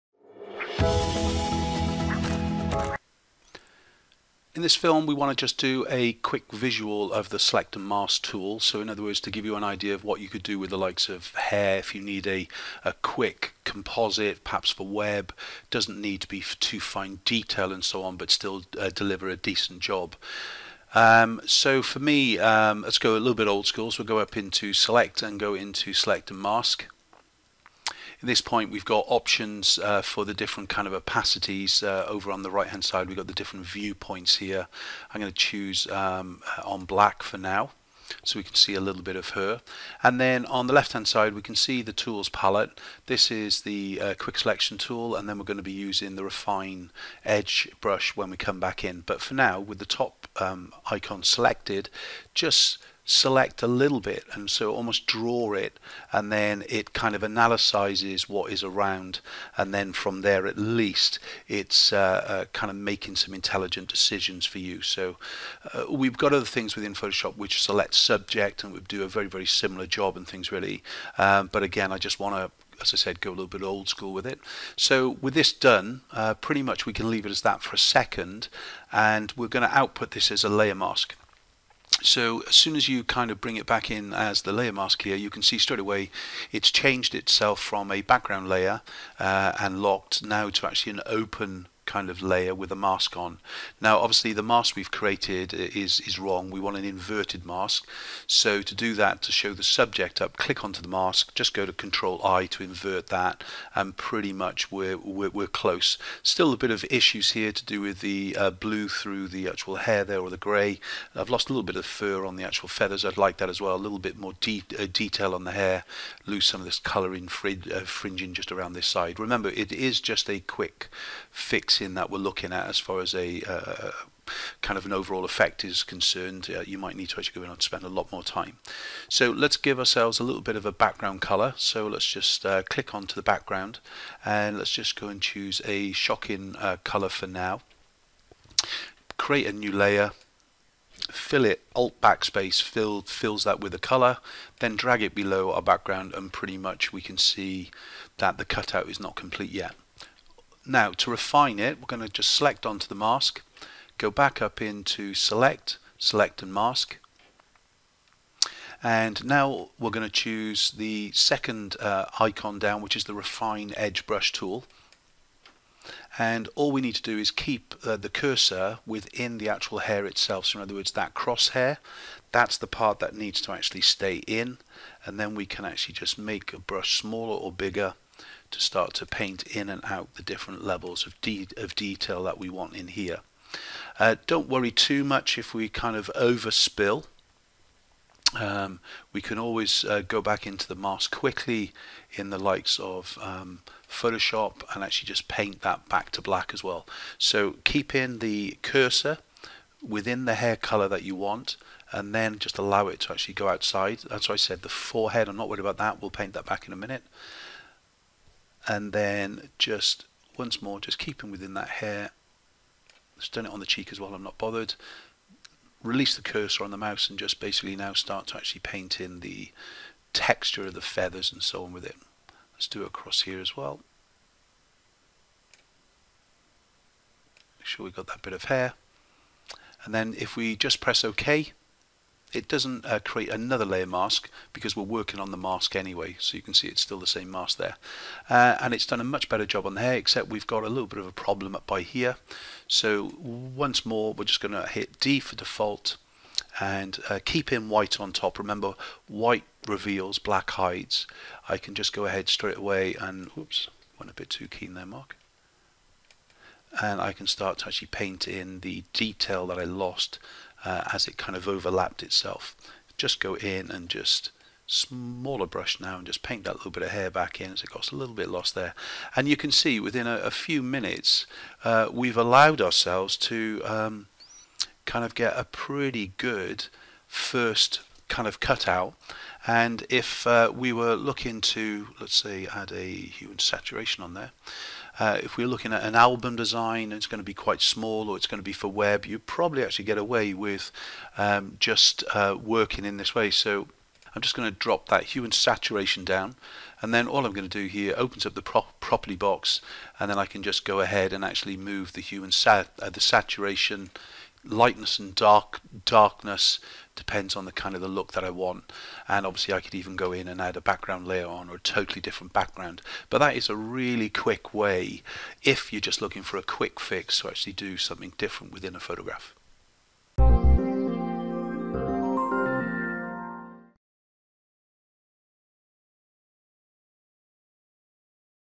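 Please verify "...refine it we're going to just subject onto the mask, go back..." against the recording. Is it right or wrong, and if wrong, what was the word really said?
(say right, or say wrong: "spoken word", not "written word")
wrong: "select", not "subject".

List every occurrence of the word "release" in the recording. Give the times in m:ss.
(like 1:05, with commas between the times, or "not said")
3:35.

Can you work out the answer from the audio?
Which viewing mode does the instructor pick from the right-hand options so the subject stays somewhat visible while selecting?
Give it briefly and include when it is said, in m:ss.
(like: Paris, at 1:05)
On black, at 0:36.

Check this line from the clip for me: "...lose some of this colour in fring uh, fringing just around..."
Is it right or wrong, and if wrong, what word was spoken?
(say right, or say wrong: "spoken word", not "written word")
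right.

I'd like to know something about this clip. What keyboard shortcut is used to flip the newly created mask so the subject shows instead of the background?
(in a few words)
Control I.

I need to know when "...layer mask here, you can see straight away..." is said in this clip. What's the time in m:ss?
1:24.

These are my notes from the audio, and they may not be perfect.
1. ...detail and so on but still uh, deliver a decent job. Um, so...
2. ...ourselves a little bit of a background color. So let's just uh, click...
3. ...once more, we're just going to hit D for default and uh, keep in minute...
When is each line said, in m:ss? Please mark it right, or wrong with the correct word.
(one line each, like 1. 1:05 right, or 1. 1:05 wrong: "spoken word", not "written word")
1. 0:17 right
2. 2:09 right
3. 4:03 wrong: "white", not "minute".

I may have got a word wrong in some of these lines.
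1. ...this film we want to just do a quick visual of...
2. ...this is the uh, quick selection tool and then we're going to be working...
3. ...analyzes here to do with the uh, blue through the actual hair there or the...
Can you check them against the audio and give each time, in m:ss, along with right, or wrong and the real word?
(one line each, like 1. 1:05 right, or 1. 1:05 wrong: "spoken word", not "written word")
1. 0:04 right
2. 0:43 wrong: "using", not "working"
3. 1:46 wrong: "issues", not "analyzes".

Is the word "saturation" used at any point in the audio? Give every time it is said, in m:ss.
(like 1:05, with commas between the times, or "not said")
4:43, 4:55, 5:03.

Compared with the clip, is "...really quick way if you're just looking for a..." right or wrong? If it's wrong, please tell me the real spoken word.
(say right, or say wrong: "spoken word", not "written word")
right.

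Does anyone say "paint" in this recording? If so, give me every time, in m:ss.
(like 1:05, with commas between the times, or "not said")
2:59, 3:15, 3:26, 3:38, 4:17, 4:26.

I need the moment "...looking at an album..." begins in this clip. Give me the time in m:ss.
4:45.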